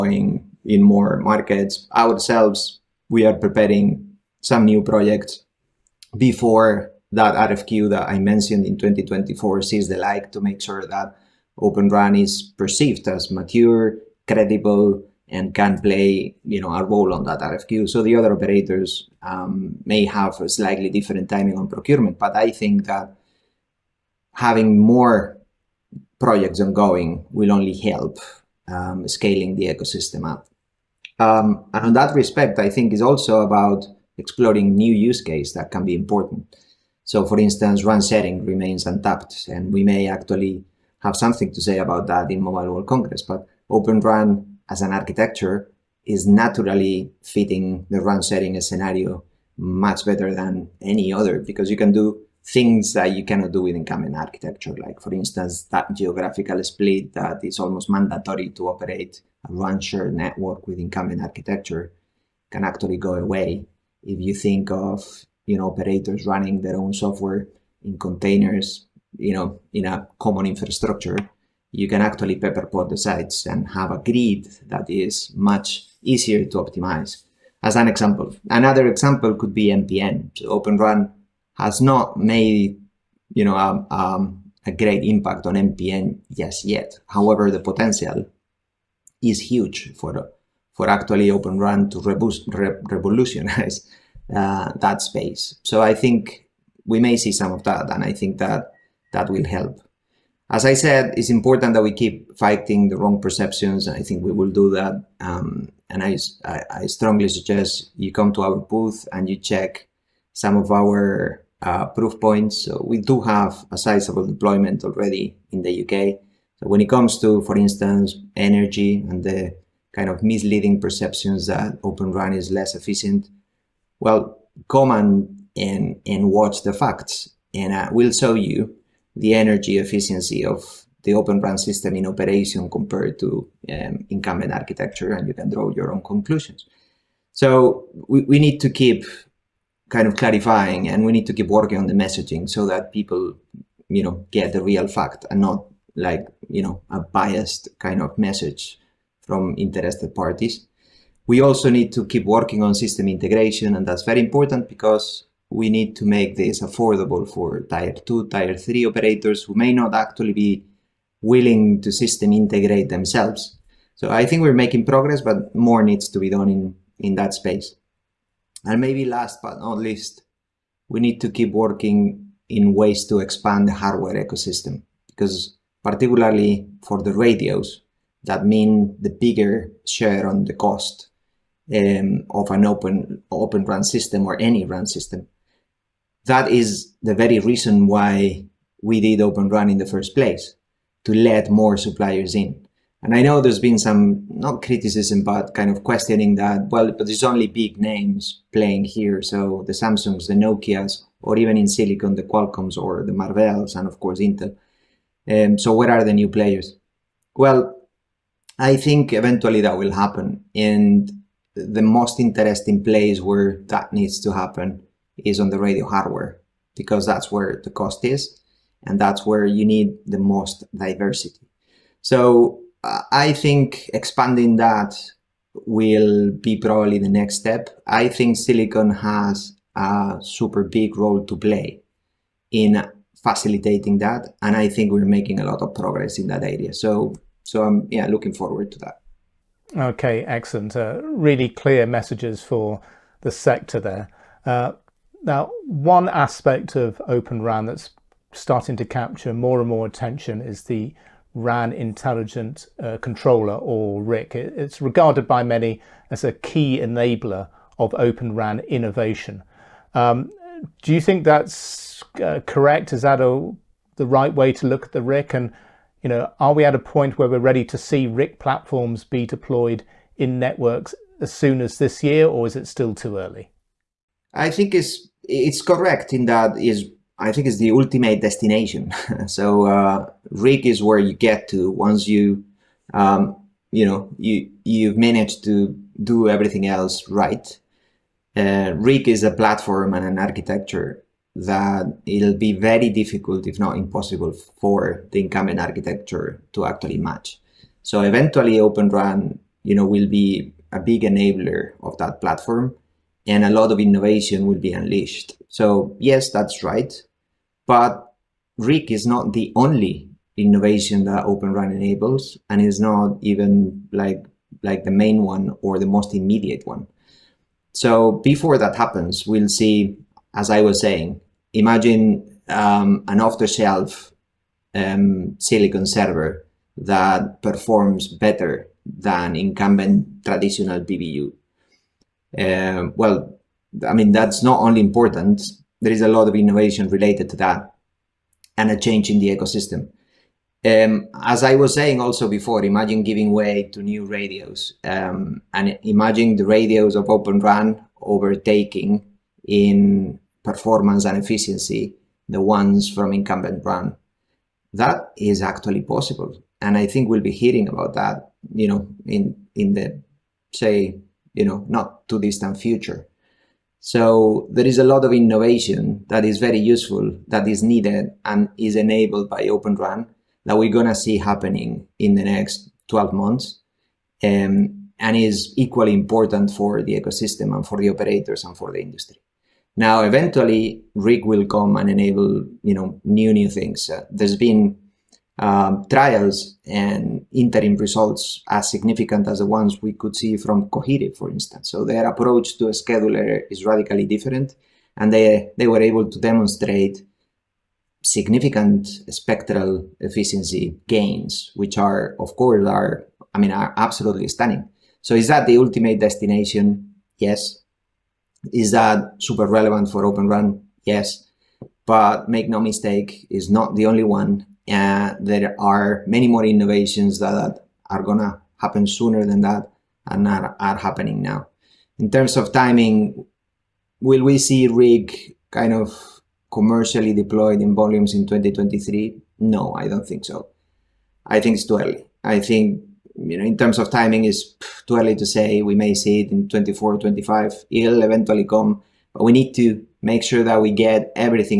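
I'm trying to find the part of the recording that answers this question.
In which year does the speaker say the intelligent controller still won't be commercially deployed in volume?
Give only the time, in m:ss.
7:08.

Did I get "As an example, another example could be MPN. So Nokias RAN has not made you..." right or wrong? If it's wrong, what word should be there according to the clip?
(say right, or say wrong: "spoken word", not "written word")
wrong: "Open", not "Nokias".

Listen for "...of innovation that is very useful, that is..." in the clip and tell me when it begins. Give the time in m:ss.
6:05.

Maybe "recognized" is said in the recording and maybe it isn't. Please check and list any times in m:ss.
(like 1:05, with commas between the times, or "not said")
not said.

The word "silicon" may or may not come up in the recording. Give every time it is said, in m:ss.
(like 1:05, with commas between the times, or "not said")
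3:21, 3:48, 5:25.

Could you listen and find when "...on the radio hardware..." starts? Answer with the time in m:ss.
3:35.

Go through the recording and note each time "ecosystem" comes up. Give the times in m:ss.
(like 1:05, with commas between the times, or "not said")
0:29, 2:54, 5:39, 6:16.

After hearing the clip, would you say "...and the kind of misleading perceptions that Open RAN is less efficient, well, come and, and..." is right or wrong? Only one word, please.
right.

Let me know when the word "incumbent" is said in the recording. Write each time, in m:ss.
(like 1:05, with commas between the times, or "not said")
0:53, 1:00, 2:14, 4:55, 5:29, 5:53.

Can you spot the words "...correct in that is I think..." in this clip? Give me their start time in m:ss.
4:35.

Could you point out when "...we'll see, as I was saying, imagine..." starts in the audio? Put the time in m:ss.
5:19.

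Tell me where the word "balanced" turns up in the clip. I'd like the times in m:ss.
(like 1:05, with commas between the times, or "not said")
not said.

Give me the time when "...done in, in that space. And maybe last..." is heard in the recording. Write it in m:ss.
2:46.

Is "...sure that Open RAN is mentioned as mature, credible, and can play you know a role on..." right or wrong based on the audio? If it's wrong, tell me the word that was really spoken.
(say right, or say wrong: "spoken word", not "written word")
wrong: "perceived", not "mentioned".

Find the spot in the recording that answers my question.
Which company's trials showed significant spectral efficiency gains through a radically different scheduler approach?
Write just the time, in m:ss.
6:30.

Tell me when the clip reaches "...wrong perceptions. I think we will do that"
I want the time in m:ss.
1:42.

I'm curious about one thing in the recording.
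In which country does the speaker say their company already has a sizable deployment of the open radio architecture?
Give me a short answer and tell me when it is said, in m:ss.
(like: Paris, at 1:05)
UK, at 1:55.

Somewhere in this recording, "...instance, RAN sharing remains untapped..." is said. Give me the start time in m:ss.
0:37.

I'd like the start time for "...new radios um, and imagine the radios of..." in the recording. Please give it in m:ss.
5:43.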